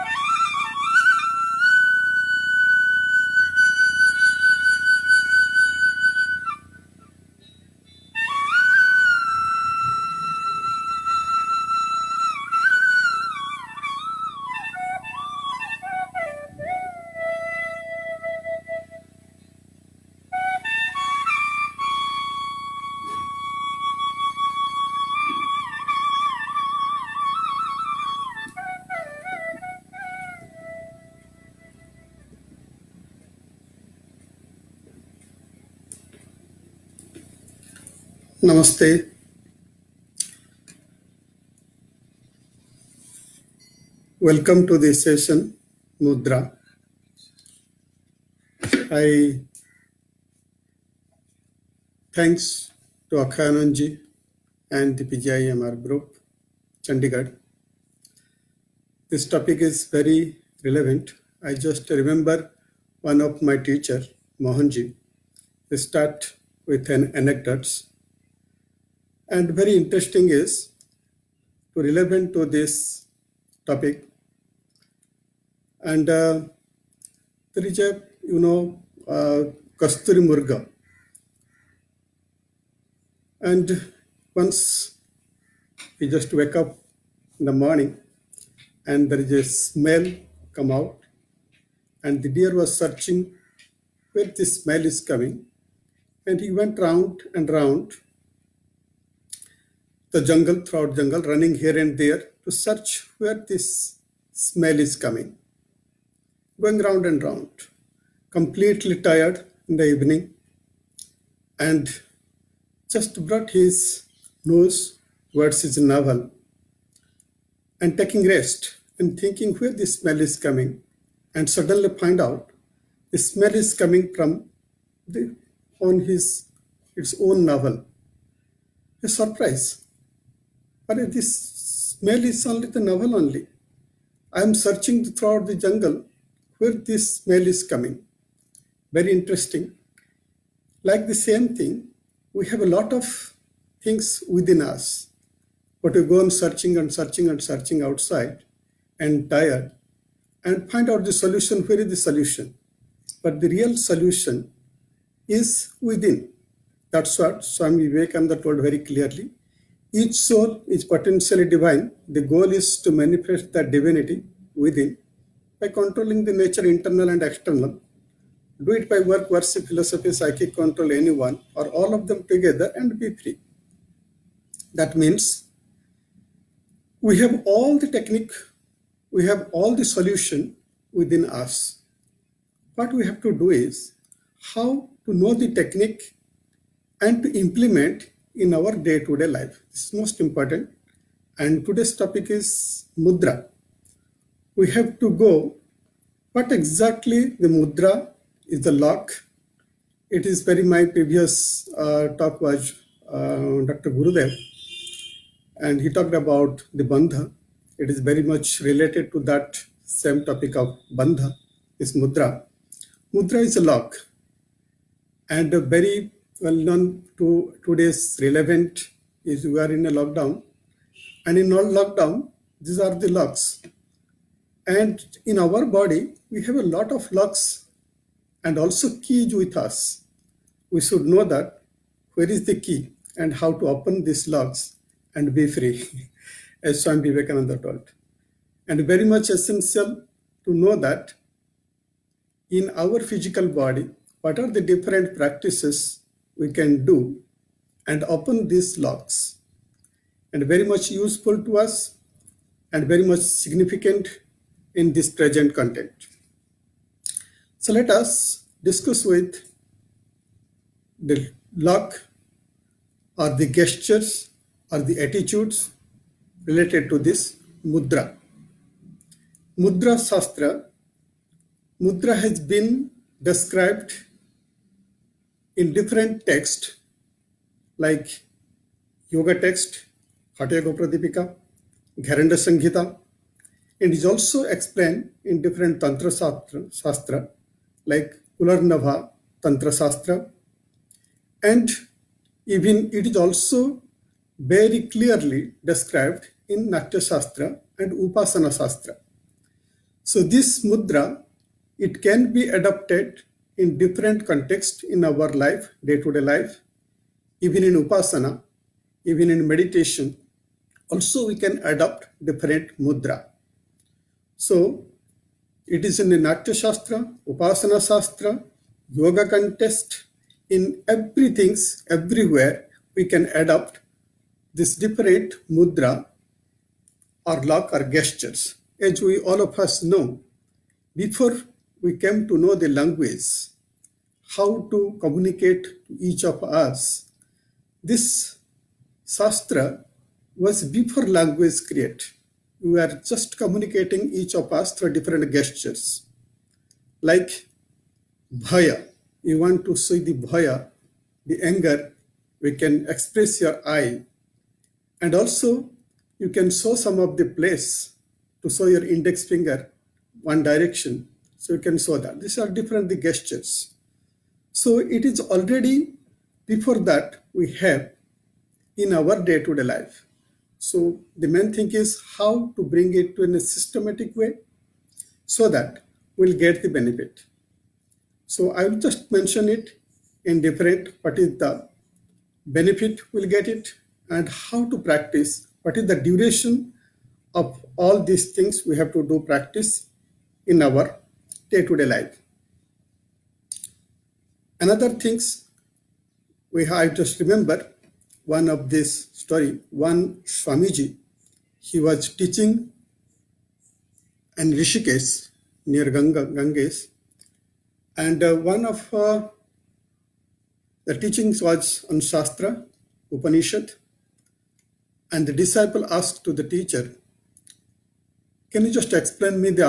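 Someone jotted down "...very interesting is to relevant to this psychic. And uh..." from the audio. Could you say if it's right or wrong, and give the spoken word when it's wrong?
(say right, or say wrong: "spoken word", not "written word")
wrong: "topic", not "psychic".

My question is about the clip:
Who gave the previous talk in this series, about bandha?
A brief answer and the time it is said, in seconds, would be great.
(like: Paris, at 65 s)
Dr. Gurudev, at 203 s.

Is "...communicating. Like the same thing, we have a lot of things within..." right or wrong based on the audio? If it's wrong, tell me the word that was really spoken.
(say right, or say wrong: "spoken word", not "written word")
wrong: "interesting", not "communicating".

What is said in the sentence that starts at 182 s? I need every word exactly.
What we have to do is how to know the technique and to implement in our day-to-day -day life.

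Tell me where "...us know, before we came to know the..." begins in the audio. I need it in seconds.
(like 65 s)
329 s.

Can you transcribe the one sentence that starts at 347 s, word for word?
Like bhaya, you want to see the bhaya, the anger, we can express your eye.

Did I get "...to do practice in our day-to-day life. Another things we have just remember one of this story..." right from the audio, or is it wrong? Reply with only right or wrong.
right.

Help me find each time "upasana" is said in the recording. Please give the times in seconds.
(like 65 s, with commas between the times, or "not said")
297 s, 307 s, 317 s.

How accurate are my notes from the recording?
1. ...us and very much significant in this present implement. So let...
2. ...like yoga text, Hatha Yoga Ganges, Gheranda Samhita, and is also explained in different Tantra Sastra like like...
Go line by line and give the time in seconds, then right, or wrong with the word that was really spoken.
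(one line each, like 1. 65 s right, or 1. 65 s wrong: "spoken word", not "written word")
1. 251 s wrong: "content", not "implement"
2. 277 s wrong: "Pradipika", not "Ganges".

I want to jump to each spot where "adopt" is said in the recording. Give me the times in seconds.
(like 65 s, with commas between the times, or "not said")
311 s, 323 s.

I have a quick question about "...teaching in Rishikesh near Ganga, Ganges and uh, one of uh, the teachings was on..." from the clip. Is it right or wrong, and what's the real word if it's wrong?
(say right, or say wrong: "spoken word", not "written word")
right.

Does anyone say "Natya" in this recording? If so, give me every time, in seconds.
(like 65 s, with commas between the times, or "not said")
296 s, 316 s.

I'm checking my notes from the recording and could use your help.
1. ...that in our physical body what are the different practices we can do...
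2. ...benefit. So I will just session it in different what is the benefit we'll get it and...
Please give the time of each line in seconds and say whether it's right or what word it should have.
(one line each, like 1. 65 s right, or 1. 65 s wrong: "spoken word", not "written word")
1. 240 s right
2. 376 s wrong: "mention", not "session".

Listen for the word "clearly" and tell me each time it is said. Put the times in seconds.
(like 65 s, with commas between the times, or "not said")
158 s, 294 s.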